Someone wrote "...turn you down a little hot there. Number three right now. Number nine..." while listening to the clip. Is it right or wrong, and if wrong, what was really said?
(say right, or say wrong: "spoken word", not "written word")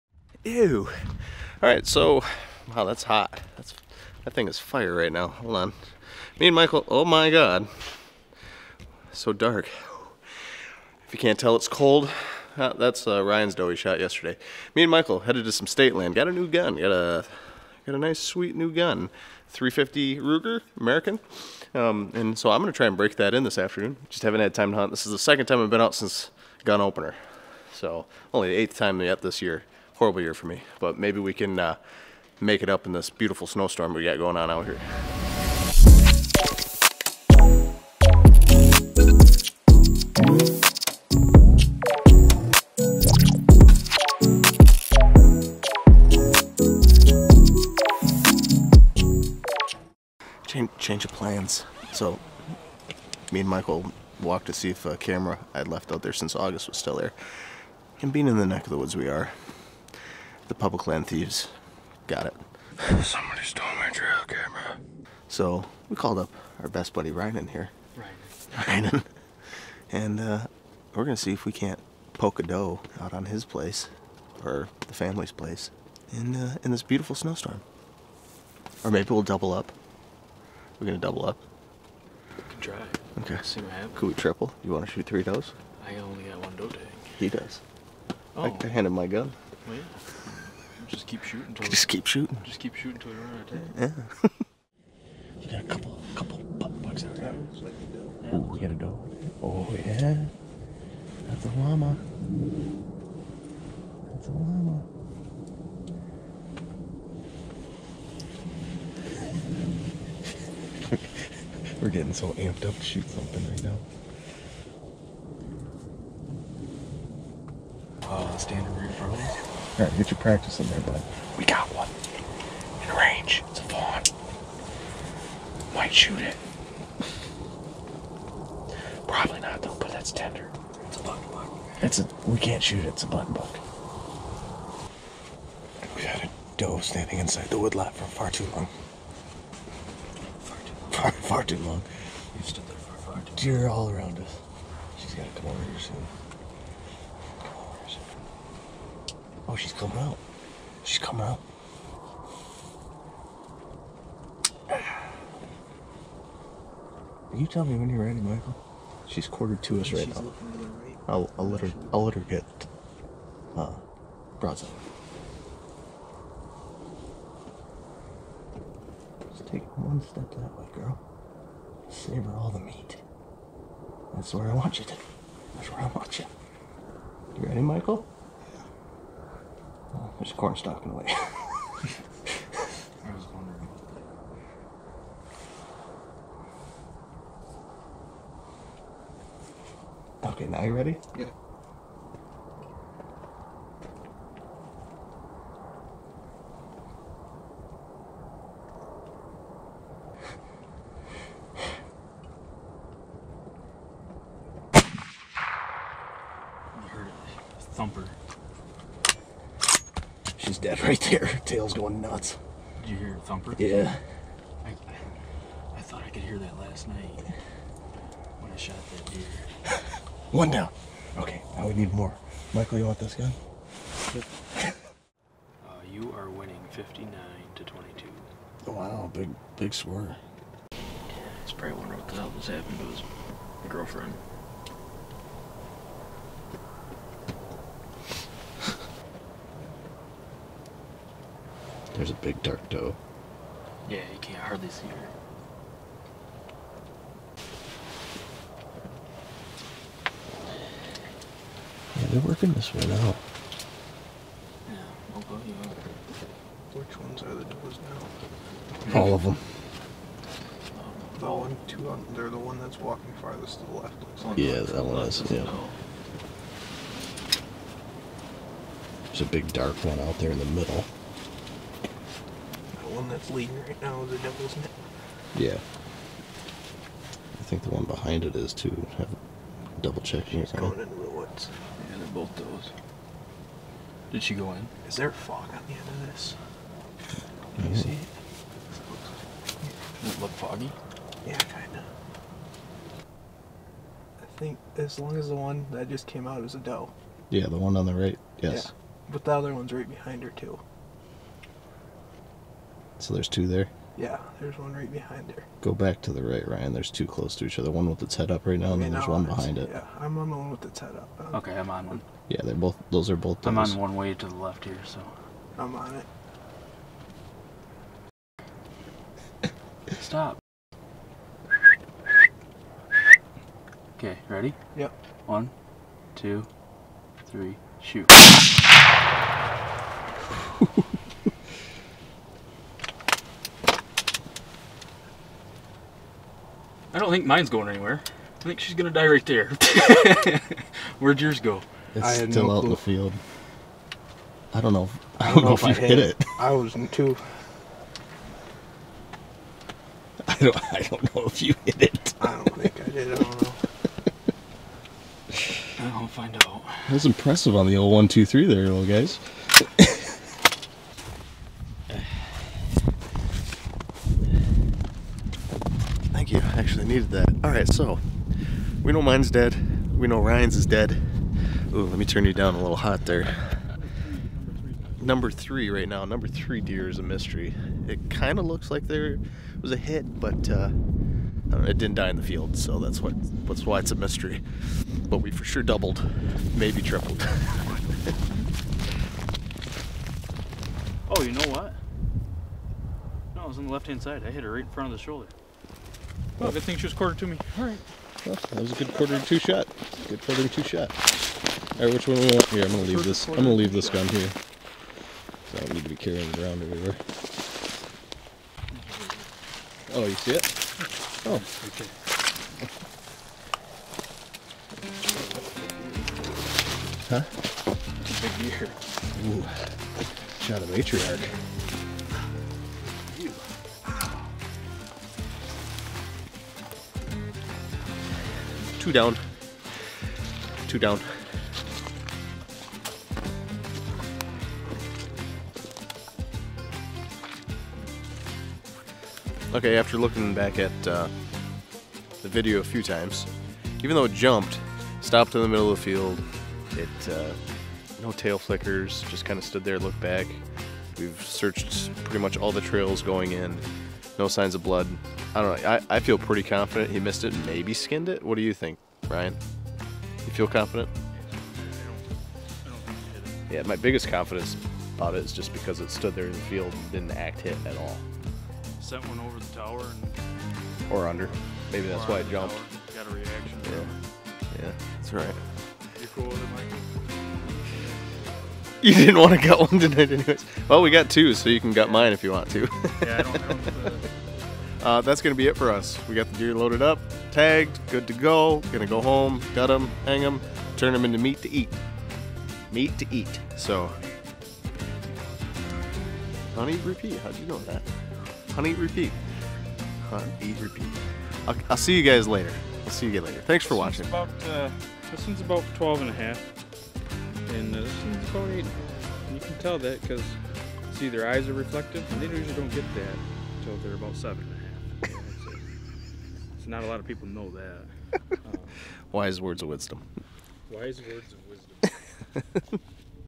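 wrong: "three", not "nine".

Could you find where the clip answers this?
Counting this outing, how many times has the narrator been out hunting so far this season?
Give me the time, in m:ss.
0:28.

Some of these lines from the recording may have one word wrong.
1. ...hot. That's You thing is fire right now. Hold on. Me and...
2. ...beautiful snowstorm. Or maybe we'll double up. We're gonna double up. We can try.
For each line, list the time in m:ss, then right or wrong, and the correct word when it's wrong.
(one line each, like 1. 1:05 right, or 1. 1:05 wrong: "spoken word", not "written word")
1. 0:03 wrong: "That", not "You"
2. 1:16 right.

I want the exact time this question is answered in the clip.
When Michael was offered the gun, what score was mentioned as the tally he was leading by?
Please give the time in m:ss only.
3:46.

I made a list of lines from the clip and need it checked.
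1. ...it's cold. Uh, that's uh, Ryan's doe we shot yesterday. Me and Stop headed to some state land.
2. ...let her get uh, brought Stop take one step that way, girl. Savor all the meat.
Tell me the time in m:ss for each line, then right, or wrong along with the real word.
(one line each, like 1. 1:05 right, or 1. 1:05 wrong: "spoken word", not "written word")
1. 0:11 wrong: "Michael", not "Stop"
2. 2:42 wrong: "Just", not "Stop".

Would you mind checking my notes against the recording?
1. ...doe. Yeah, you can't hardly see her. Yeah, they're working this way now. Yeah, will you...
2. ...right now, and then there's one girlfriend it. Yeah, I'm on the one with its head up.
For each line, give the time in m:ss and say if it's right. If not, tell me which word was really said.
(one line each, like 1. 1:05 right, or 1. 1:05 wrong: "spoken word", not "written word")
1. 4:02 right
2. 5:08 wrong: "behind", not "girlfriend".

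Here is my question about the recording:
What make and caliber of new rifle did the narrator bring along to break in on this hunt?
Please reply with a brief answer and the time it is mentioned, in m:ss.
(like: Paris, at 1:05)
350 Ruger American, at 0:19.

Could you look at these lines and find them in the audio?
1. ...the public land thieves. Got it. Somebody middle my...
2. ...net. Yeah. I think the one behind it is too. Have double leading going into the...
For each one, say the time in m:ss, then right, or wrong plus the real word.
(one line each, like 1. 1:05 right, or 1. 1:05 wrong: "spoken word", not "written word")
1. 1:00 wrong: "stole", not "middle"
2. 4:34 wrong: "checking", not "leading".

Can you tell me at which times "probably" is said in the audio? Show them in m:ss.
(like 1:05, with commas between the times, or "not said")
2:09, 3:51.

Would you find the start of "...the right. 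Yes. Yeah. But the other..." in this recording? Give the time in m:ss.
4:57.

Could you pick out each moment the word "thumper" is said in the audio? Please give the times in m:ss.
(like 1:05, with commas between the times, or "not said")
3:27, 3:33.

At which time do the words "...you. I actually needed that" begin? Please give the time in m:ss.
6:06.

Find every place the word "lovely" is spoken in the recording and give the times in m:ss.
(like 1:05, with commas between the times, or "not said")
not said.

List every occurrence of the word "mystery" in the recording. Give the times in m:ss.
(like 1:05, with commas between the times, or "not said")
6:17, 6:23.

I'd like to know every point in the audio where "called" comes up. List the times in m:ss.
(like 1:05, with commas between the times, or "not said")
1:05.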